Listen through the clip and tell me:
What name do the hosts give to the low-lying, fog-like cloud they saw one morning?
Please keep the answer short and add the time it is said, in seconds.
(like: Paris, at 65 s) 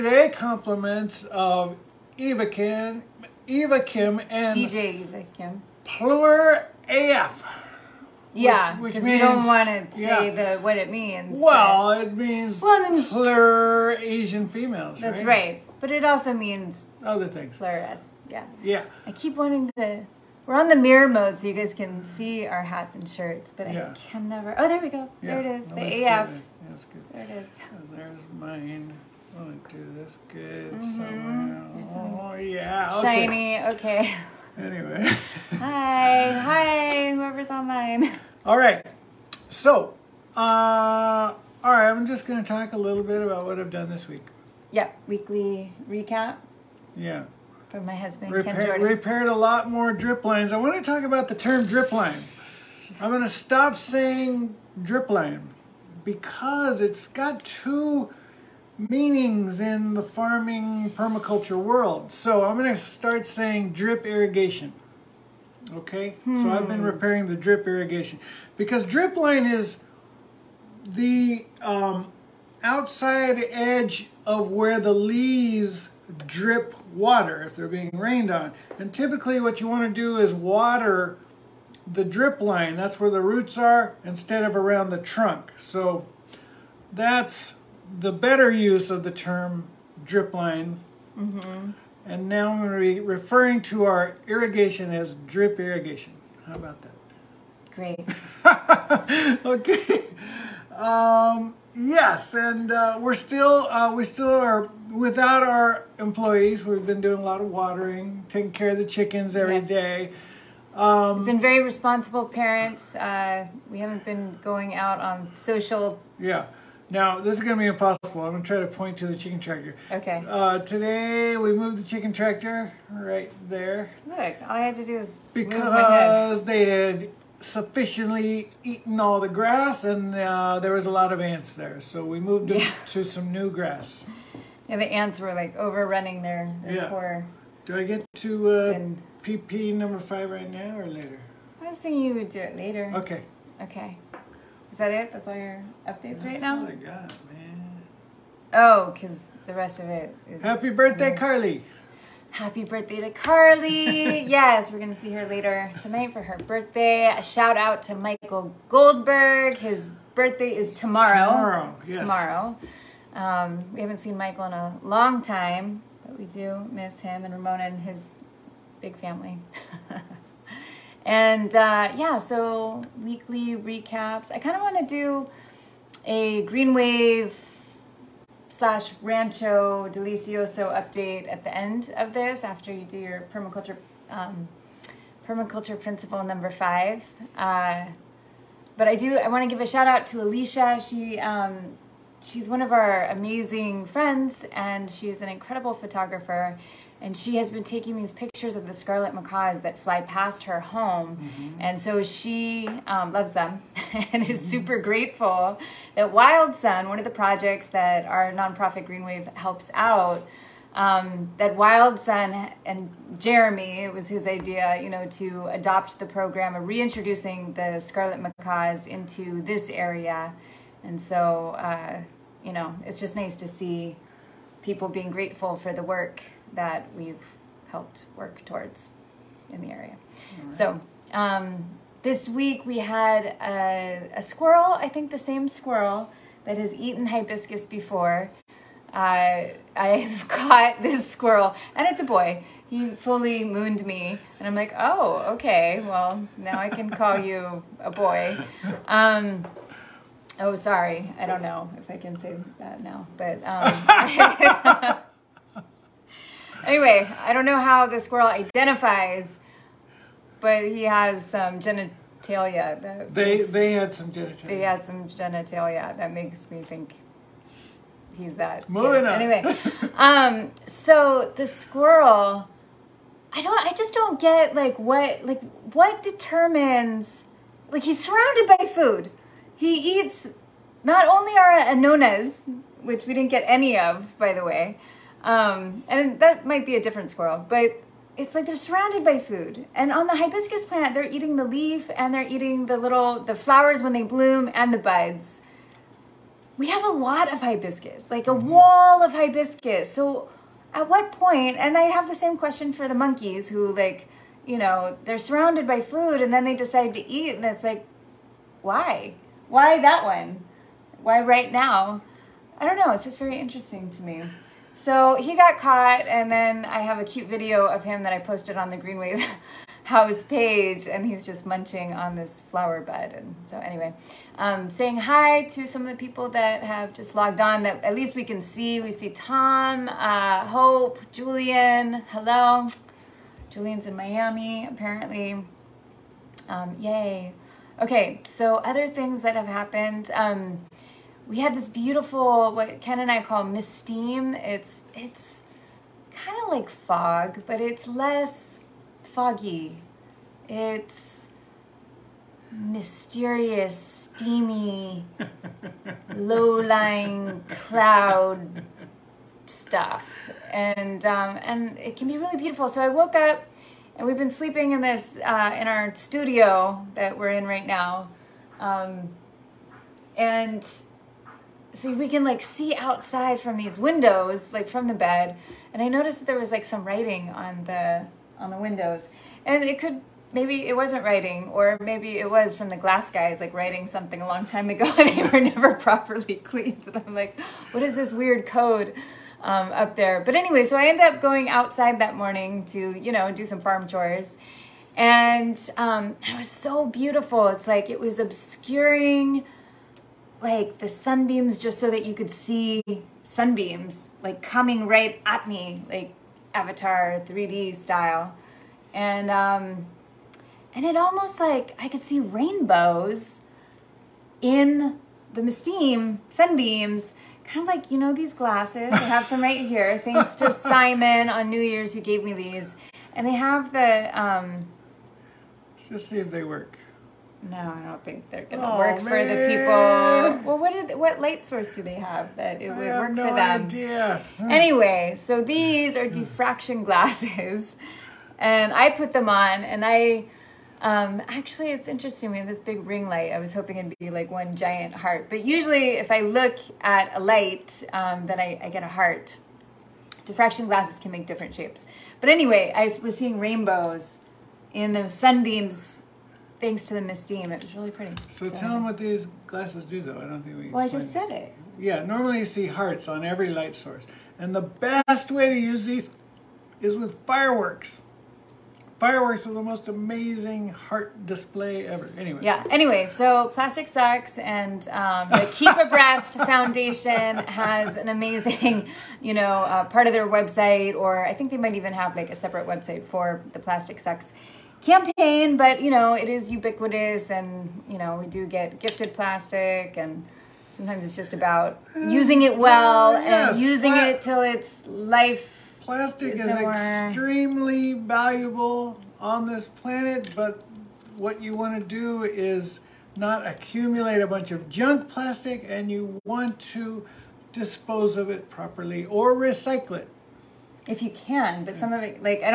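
mist steam, at 343 s.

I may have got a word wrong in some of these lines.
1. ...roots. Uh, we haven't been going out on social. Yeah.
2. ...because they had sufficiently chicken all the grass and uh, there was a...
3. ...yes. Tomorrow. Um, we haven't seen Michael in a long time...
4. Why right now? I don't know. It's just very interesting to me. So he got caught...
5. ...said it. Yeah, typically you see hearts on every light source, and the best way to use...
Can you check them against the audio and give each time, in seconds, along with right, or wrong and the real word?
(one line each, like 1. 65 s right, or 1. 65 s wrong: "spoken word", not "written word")
1. 112 s wrong: "parents", not "roots"
2. 125 s wrong: "eaten", not "chicken"
3. 161 s right
4. 311 s right
5. 461 s wrong: "normally", not "typically".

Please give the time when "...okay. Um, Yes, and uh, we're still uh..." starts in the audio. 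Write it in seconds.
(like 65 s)
99 s.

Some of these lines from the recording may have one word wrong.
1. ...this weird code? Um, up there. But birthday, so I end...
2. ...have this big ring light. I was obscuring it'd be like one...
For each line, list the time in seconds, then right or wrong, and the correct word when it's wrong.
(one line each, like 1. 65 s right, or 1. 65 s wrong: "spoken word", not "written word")
1. 387 s wrong: "anyway", not "birthday"
2. 442 s wrong: "hoping", not "obscuring".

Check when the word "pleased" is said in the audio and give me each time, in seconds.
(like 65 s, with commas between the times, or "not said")
not said.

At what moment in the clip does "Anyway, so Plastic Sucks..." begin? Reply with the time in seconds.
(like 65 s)
472 s.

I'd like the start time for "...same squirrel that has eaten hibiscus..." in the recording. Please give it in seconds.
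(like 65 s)
235 s.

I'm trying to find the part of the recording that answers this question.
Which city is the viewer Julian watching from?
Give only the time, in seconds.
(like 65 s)
333 s.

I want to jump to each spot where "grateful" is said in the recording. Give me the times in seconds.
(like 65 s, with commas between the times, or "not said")
204 s, 225 s.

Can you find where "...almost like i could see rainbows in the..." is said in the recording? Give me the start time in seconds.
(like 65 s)
410 s.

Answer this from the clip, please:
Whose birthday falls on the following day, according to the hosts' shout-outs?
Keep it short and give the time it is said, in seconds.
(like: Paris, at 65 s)
Michael Goldberg, at 157 s.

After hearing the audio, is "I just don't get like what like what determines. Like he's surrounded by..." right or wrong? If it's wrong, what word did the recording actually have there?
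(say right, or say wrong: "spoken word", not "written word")
right.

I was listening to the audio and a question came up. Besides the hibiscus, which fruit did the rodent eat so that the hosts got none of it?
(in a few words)
anonas.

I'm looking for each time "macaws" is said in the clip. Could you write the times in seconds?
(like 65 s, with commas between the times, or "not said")
199 s, 218 s.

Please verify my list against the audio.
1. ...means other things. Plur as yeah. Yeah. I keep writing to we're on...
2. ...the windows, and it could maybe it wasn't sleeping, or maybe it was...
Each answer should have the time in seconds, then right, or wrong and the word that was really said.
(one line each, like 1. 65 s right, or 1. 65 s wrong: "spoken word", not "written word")
1. 16 s wrong: "wanting", not "writing"
2. 378 s wrong: "writing", not "sleeping".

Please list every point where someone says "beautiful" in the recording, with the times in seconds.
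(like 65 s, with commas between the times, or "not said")
341 s, 362 s, 396 s.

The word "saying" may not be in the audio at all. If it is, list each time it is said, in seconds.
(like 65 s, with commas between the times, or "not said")
53 s, 63 s, 324 s.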